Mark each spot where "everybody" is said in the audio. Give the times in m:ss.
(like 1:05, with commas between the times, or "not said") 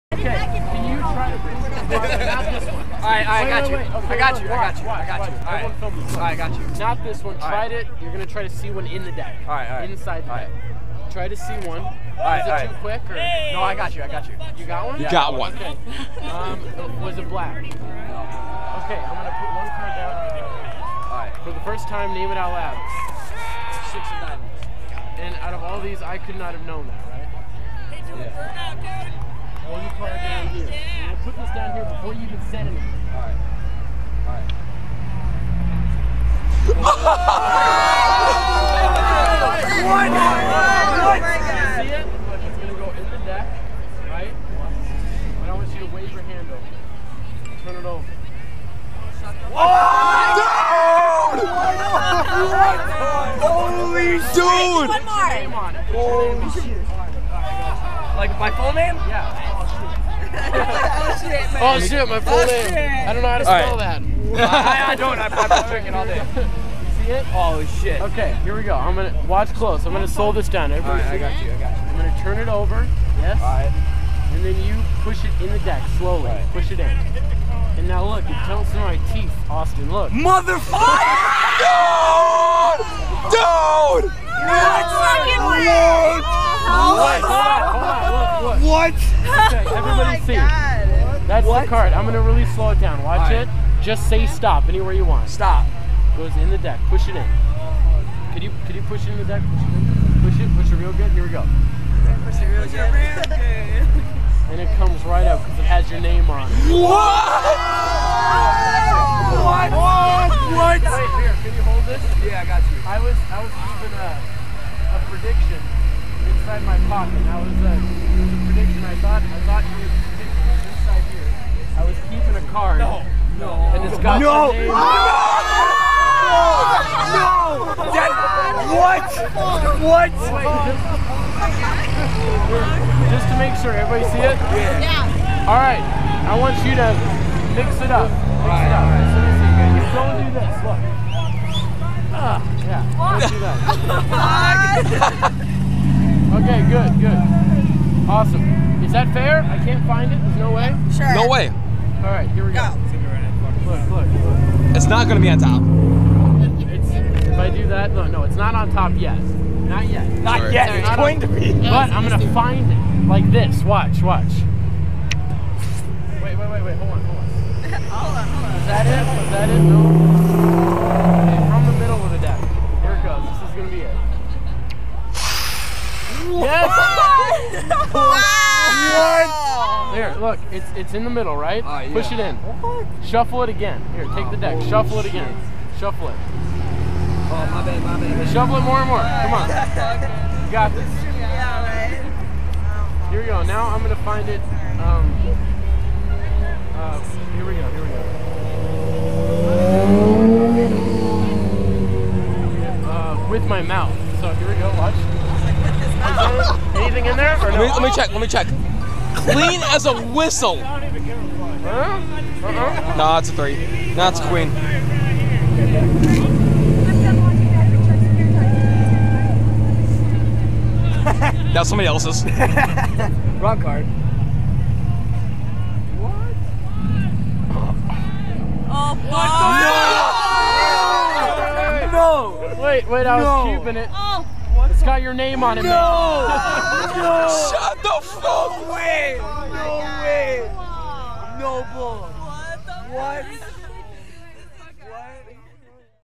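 1:10, 2:13.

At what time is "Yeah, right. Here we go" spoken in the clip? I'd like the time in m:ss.
3:11.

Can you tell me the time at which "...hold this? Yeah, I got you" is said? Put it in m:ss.
1:51.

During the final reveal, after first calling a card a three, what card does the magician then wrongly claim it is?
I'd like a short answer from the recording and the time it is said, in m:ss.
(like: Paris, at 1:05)
Queen, at 3:34.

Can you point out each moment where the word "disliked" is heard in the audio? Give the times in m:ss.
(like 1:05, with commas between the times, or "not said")
not said.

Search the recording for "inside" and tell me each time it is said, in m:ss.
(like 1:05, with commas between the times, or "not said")
0:09, 1:56.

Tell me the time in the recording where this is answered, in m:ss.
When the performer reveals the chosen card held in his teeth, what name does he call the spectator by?
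1:19.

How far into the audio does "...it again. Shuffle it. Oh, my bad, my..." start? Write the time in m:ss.
3:04.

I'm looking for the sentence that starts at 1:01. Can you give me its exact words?
Oh shit, my full oh, name.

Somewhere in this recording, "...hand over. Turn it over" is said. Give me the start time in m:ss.
0:46.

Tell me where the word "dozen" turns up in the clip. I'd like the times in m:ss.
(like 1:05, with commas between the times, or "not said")
not said.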